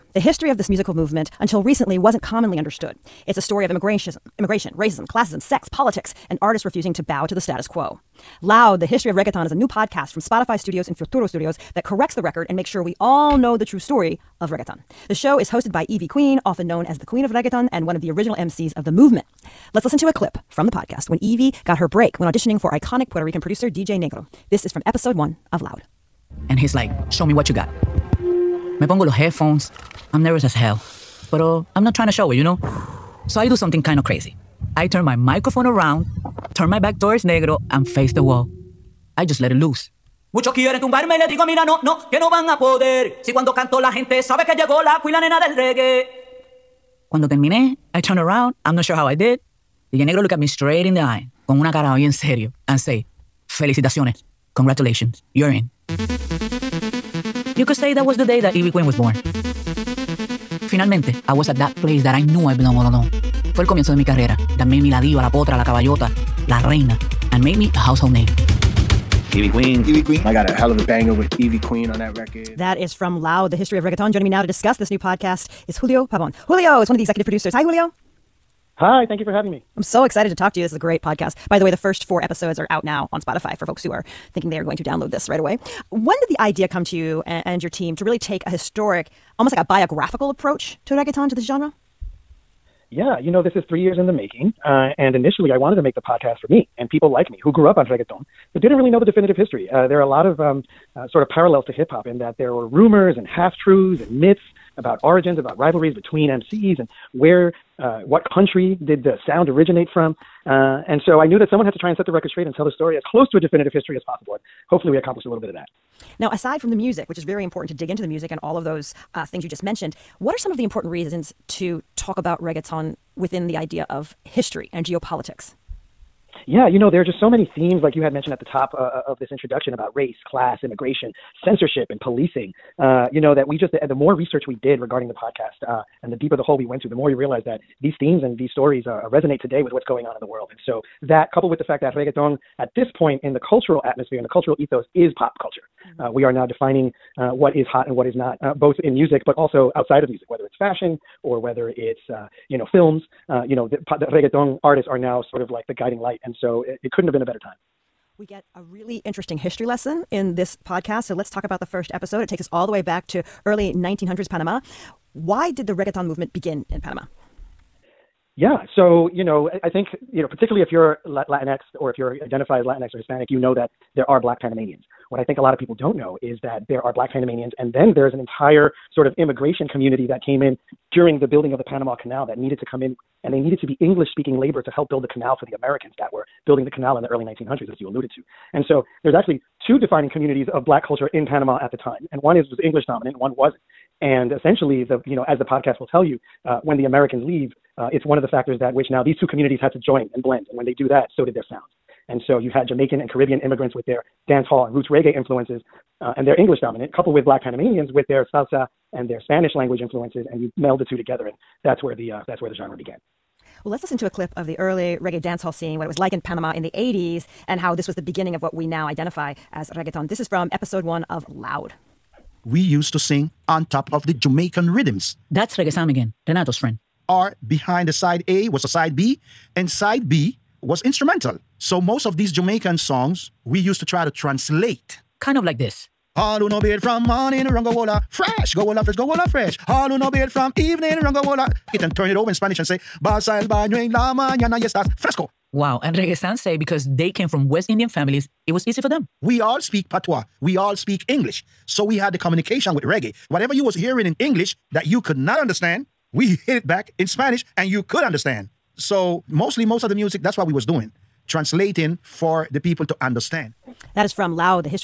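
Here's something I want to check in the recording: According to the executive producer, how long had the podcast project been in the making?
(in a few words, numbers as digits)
3 years.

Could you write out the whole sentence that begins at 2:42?
It takes us all the way back to early 1900s Panama why did the reggaeton movement begin in Panama?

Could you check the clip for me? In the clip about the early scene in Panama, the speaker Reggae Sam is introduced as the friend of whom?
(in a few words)
Renato.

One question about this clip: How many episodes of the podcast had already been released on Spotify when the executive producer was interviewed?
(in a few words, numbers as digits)
4.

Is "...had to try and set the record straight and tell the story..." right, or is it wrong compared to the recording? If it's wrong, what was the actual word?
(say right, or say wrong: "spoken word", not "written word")
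right.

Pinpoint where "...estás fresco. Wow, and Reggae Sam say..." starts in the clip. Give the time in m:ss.
4:04.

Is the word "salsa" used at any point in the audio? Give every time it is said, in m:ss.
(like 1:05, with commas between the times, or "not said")
3:28.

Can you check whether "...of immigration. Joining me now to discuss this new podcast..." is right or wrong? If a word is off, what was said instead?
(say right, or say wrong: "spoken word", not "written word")
wrong: "reggaeton", not "immigration".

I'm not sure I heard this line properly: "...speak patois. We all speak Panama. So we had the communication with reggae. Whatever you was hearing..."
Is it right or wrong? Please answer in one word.
wrong.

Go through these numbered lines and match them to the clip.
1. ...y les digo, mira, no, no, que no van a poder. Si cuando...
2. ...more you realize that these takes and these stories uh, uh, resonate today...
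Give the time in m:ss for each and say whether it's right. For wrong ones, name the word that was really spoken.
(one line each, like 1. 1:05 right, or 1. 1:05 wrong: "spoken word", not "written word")
1. 0:41 right
2. 2:16 wrong: "themes", not "takes".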